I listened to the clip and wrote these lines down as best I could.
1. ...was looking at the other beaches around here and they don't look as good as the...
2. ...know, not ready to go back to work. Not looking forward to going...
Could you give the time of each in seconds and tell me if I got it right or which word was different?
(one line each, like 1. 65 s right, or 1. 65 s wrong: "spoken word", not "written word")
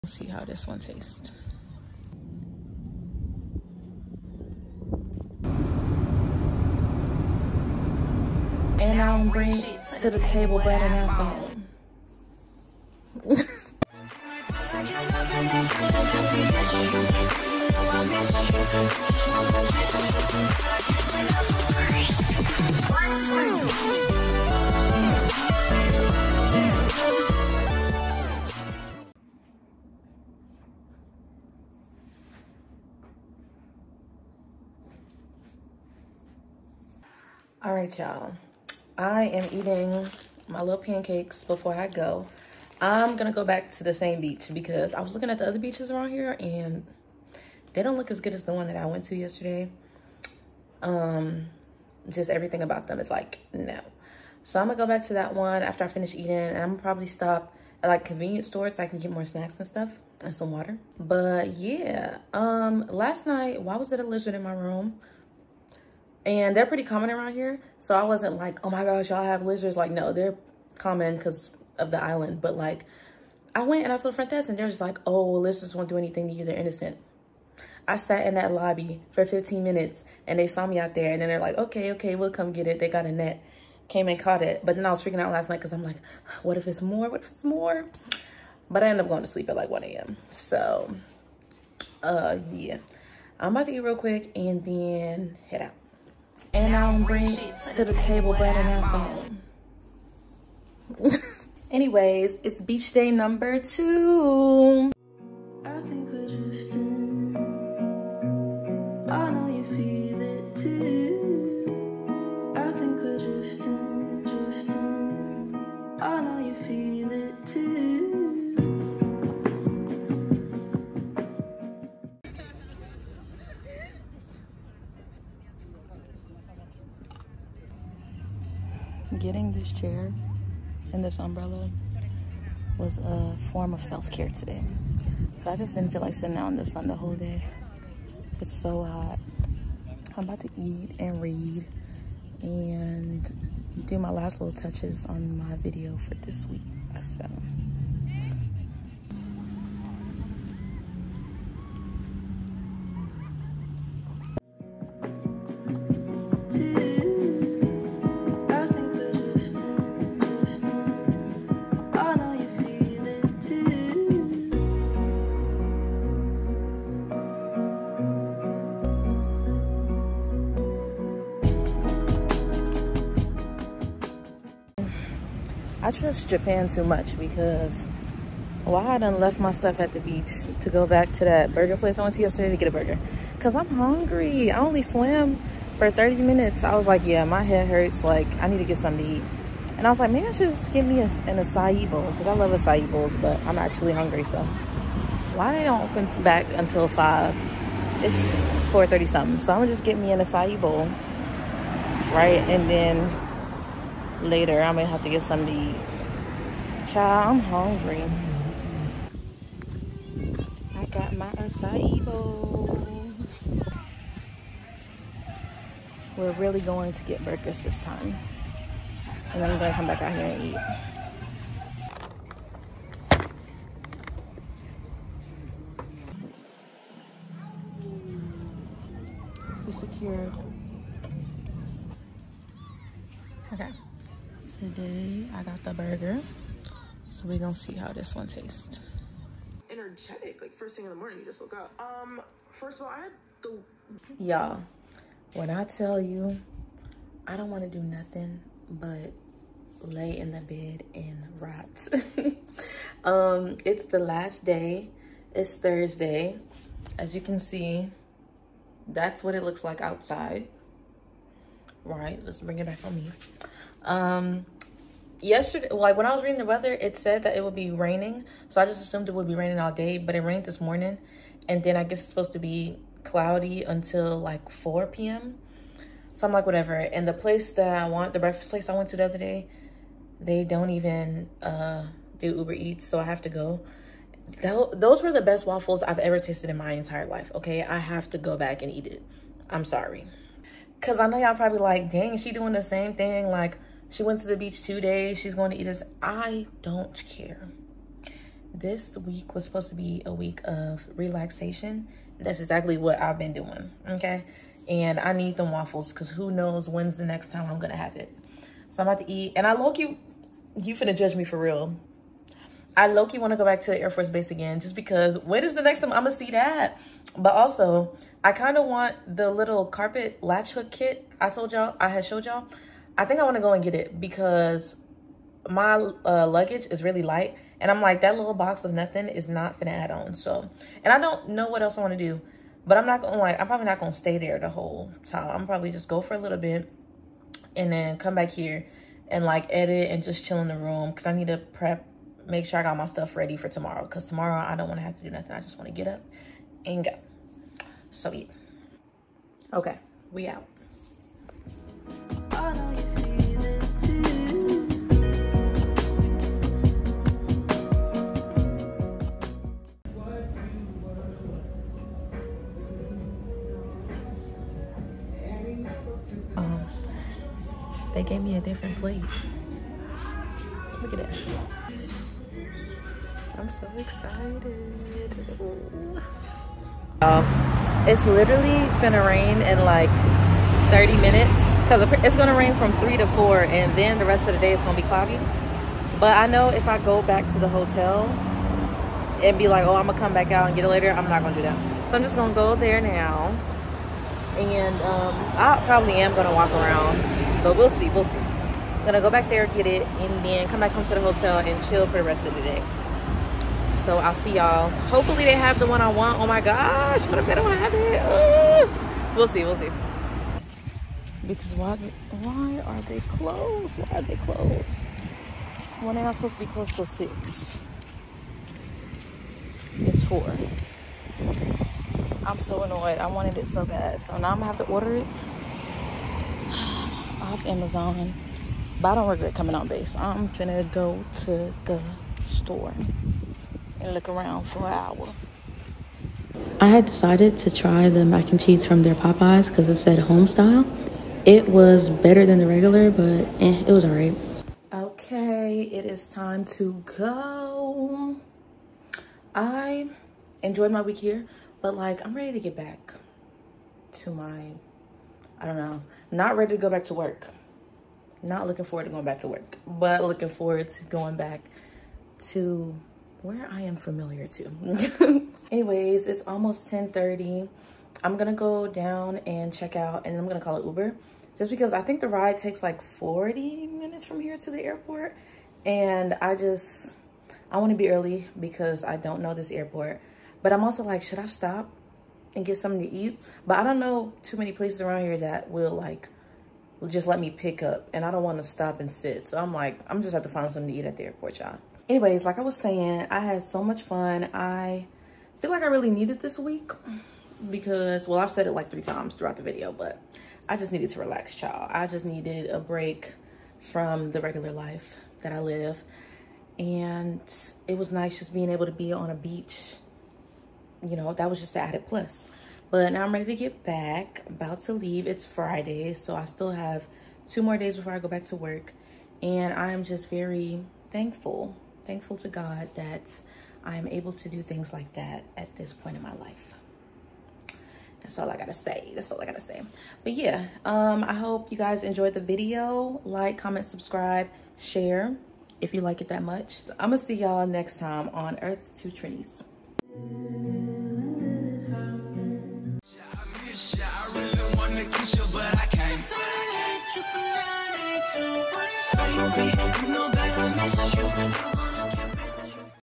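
1. 45 s right
2. 455 s right.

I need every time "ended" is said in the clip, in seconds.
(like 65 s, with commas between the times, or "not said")
88 s.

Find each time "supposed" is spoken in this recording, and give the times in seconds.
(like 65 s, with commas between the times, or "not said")
272 s, 299 s, 416 s.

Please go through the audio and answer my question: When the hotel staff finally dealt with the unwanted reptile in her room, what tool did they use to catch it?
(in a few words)
A net.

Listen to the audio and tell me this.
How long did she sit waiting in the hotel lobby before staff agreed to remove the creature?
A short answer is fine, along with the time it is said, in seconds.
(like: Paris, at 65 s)
15 minutes, at 79 s.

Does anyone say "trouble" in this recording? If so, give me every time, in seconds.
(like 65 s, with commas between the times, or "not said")
not said.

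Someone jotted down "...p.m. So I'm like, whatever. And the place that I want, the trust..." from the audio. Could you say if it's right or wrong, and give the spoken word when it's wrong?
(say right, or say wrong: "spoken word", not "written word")
wrong: "breakfast", not "trust".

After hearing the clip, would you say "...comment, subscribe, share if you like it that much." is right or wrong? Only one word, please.
right.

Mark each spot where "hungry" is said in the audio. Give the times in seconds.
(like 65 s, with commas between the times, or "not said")
183 s, 193 s, 207 s.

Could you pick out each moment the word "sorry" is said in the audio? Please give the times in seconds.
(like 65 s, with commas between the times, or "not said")
289 s.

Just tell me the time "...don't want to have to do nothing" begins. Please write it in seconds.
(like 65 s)
344 s.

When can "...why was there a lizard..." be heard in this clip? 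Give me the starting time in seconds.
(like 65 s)
63 s.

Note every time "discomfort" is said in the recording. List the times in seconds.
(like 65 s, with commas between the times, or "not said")
not said.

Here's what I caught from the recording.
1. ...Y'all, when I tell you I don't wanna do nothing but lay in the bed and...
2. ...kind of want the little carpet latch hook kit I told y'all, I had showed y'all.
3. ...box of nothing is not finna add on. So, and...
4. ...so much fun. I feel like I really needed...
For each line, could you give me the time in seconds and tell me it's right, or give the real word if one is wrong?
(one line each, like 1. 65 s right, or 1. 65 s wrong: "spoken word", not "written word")
1. 244 s right
2. 318 s right
3. 328 s right
4. 493 s right.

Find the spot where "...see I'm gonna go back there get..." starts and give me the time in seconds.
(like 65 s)
398 s.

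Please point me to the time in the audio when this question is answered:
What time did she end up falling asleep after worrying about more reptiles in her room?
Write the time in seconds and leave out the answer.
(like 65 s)
89 s.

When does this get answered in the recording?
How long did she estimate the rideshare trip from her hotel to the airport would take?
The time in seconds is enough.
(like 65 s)
472 s.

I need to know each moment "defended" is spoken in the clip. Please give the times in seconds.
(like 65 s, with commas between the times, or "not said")
not said.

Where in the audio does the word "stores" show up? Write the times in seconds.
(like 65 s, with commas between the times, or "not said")
58 s, 432 s.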